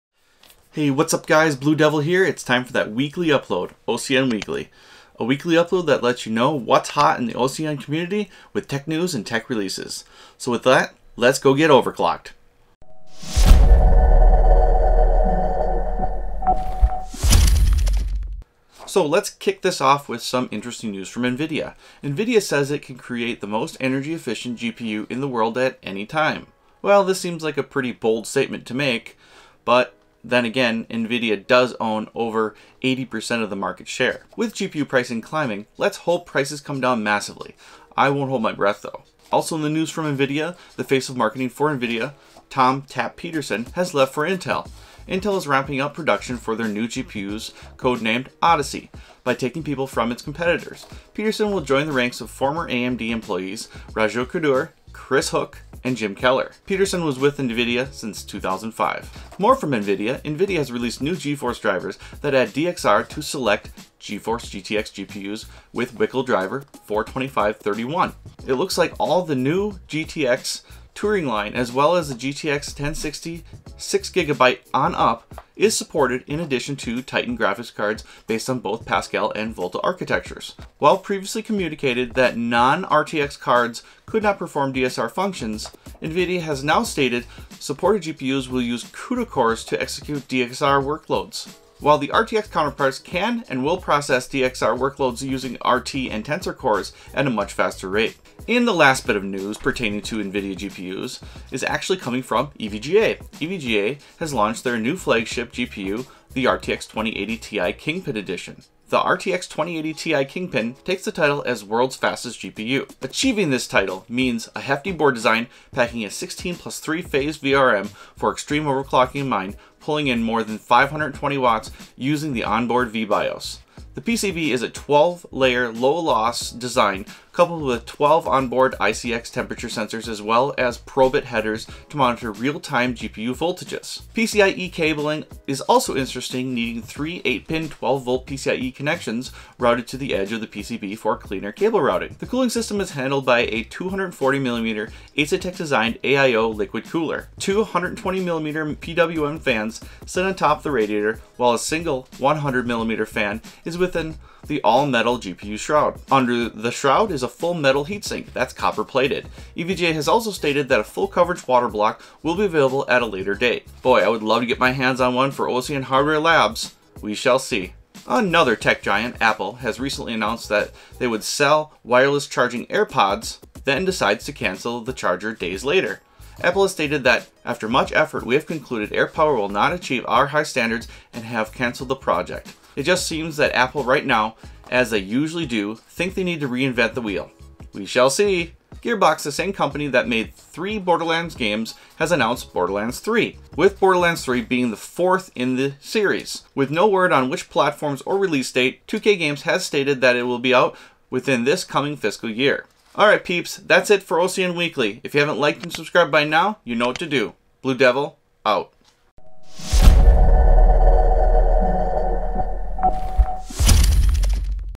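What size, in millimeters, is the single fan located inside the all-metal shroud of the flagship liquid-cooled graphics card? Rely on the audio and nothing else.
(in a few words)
100mm.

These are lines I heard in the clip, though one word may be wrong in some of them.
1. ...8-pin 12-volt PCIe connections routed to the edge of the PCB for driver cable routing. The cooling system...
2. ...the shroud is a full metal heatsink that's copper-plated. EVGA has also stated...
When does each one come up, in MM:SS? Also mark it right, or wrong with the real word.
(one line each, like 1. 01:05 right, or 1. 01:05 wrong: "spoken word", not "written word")
1. 02:17 wrong: "cleaner", not "driver"
2. 02:36 right.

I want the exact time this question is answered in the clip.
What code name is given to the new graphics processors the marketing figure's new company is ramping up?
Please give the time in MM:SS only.
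00:48.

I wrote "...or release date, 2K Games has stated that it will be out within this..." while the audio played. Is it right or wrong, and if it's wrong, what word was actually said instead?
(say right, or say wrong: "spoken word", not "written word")
right.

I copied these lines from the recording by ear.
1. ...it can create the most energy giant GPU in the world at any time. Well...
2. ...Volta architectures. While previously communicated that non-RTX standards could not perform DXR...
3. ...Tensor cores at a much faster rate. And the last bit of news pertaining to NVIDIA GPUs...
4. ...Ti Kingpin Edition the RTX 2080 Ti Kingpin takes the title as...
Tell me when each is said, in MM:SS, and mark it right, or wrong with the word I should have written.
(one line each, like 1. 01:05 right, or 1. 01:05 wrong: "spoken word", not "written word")
1. 00:22 wrong: "efficient", not "giant"
2. 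01:19 wrong: "cards", not "standards"
3. 01:36 right
4. 01:47 right.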